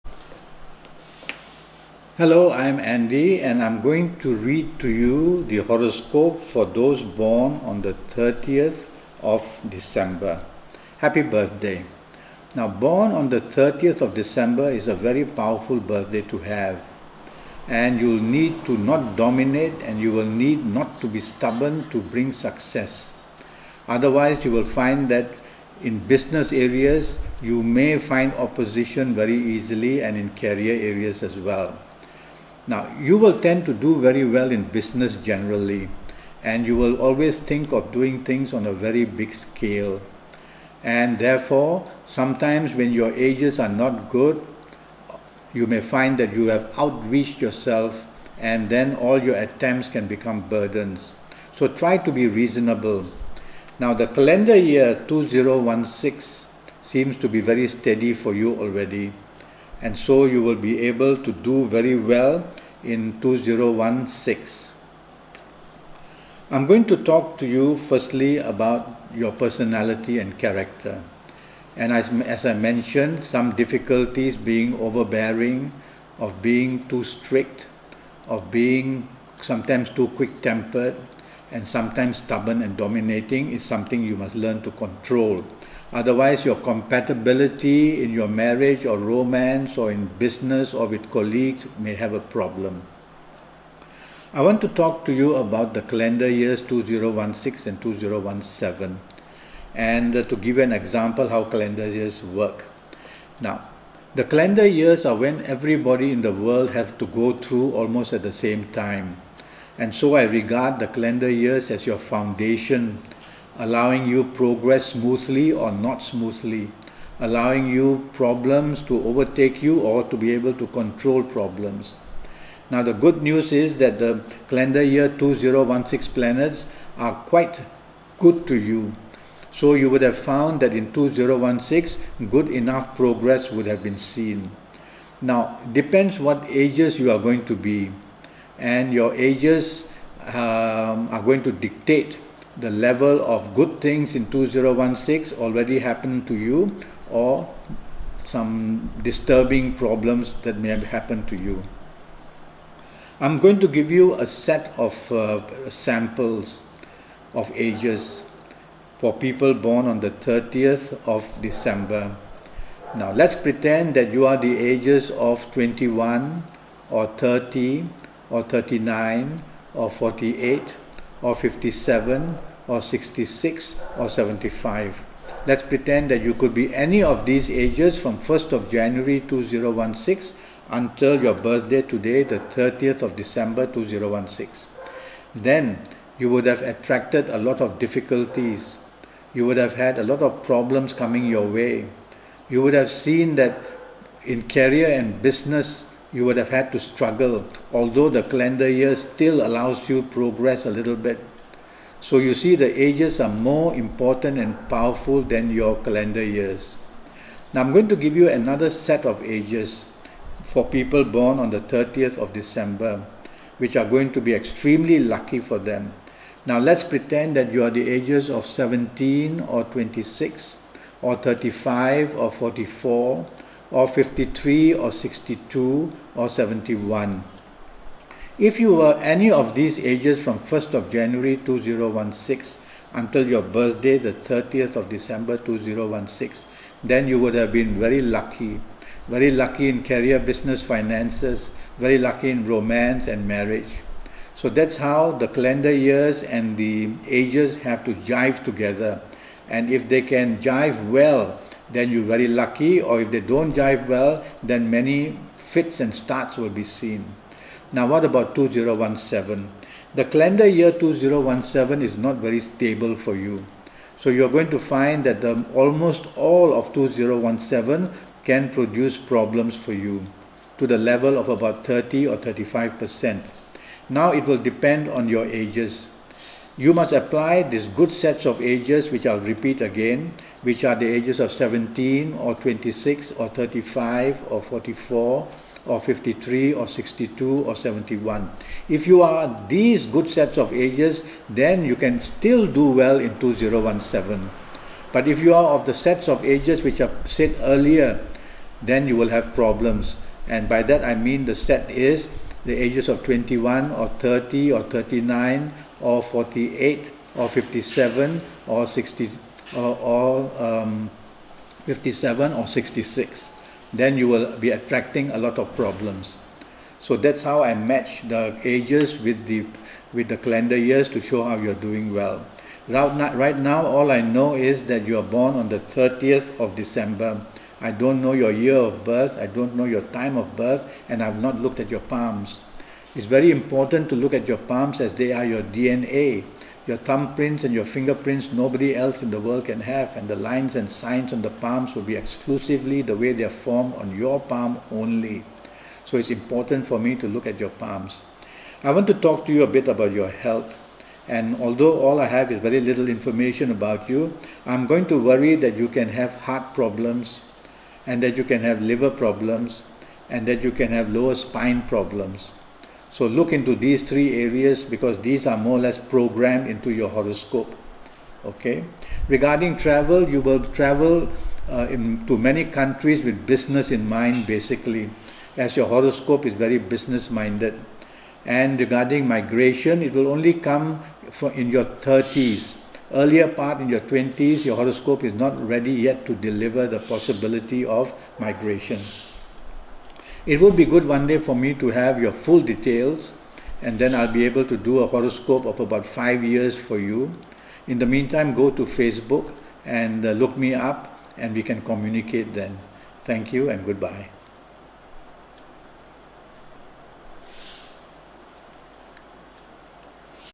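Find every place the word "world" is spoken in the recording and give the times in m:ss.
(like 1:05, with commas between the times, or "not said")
1:46, 5:39.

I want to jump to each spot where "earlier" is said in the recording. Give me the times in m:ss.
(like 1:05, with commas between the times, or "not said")
4:57, 6:22.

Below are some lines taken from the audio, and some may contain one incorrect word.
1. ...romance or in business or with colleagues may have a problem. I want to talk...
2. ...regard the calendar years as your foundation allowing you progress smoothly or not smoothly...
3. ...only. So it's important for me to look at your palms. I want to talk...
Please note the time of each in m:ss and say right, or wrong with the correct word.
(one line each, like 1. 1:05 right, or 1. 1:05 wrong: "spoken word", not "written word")
1. 1:28 right
2. 1:50 right
3. 5:44 right.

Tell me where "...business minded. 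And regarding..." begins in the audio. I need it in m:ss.
6:16.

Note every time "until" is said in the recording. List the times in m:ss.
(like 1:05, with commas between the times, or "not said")
3:00, 3:52.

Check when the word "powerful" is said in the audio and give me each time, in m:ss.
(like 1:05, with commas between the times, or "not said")
0:15, 3:24.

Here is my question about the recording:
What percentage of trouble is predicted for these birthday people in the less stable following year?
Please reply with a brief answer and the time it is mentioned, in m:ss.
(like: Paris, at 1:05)
30 or 35 percent, at 4:31.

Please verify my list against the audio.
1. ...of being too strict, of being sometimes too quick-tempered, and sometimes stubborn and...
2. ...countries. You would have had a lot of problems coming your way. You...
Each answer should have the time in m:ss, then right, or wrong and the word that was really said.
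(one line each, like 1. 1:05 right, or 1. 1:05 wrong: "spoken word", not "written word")
1. 1:16 right
2. 3:07 wrong: "difficulties", not "countries".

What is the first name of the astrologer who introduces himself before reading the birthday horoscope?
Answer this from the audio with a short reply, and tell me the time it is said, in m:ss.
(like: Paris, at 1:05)
Andi, at 0:02.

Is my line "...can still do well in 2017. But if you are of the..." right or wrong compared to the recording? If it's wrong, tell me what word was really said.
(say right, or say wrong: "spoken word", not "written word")
right.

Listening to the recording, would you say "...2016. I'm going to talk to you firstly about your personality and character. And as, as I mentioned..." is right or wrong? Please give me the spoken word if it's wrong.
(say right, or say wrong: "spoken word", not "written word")
right.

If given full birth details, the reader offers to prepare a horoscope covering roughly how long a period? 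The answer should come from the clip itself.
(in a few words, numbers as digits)
about five years.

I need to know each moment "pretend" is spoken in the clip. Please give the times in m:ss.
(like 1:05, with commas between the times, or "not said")
2:43, 2:55, 3:36.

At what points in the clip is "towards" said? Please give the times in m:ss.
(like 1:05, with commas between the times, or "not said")
not said.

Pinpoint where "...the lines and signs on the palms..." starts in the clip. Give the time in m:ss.
5:40.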